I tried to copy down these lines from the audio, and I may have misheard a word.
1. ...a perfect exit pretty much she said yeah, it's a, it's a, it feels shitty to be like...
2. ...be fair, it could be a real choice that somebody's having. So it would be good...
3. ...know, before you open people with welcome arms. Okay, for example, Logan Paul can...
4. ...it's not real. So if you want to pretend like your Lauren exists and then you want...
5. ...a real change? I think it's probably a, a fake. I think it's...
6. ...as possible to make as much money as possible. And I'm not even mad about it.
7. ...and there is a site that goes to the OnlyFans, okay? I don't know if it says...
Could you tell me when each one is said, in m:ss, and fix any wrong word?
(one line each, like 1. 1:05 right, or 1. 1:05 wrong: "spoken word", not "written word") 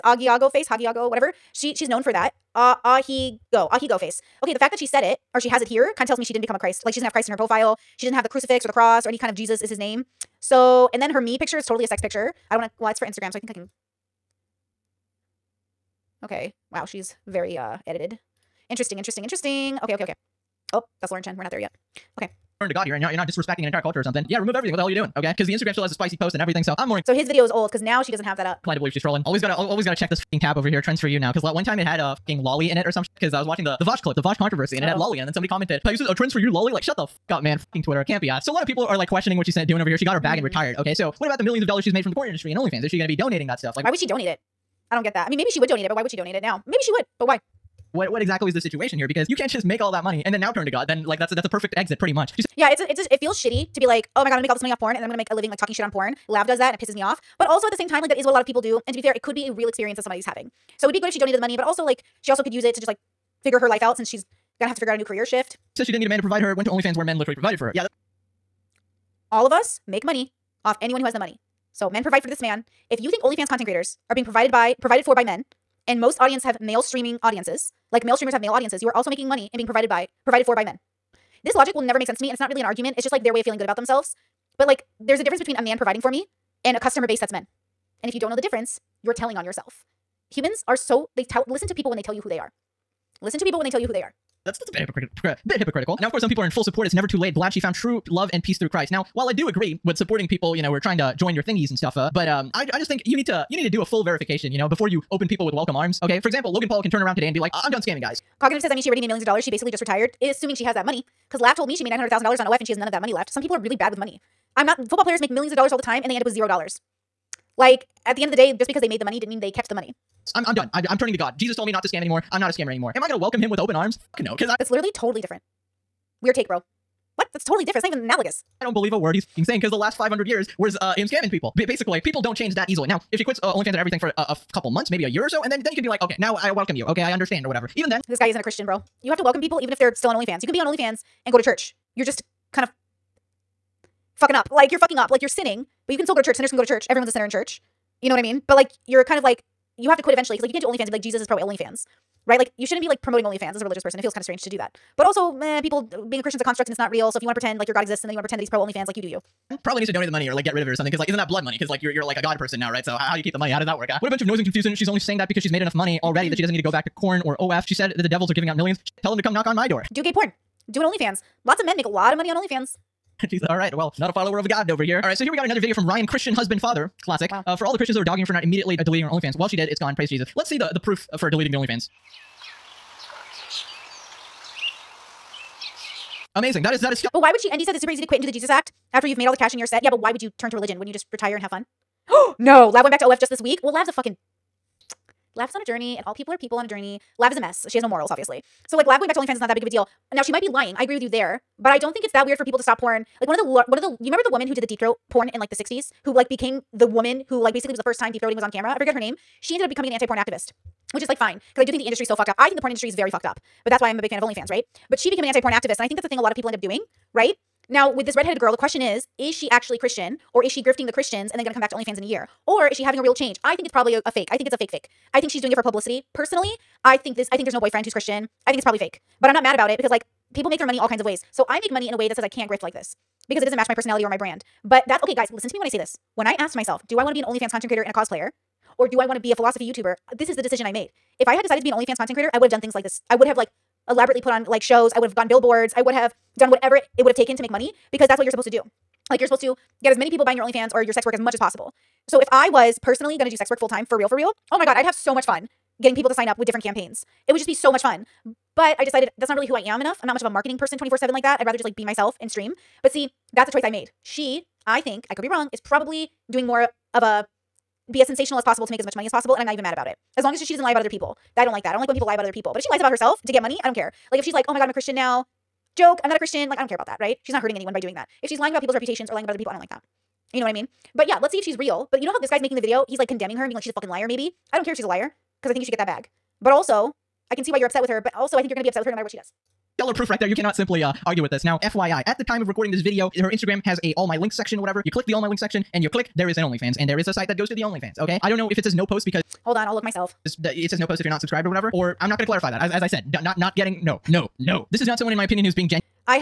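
1. 0:51 right
2. 0:58 wrong: "experience", not "choice"
3. 1:44 right
4. 2:36 wrong: "God", not "Lauren"
5. 3:42 right
6. 4:28 right
7. 4:56 right.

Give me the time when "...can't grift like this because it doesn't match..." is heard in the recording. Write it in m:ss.
3:52.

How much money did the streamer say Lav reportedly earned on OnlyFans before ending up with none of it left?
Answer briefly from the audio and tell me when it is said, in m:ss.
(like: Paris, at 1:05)
$900,000, at 1:51.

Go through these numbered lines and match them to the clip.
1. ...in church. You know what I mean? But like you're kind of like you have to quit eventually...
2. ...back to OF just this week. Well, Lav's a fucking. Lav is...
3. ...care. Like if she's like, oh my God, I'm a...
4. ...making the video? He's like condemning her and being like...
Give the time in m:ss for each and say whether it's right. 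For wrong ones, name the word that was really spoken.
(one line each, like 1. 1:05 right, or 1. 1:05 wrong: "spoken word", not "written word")
1. 2:27 right
2. 3:12 right
3. 4:33 right
4. 4:42 right.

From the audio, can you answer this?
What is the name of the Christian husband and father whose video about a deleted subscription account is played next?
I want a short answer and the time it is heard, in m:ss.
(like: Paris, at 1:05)
Ryan, at 2:55.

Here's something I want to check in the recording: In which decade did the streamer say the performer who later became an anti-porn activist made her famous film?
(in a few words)
the 60s.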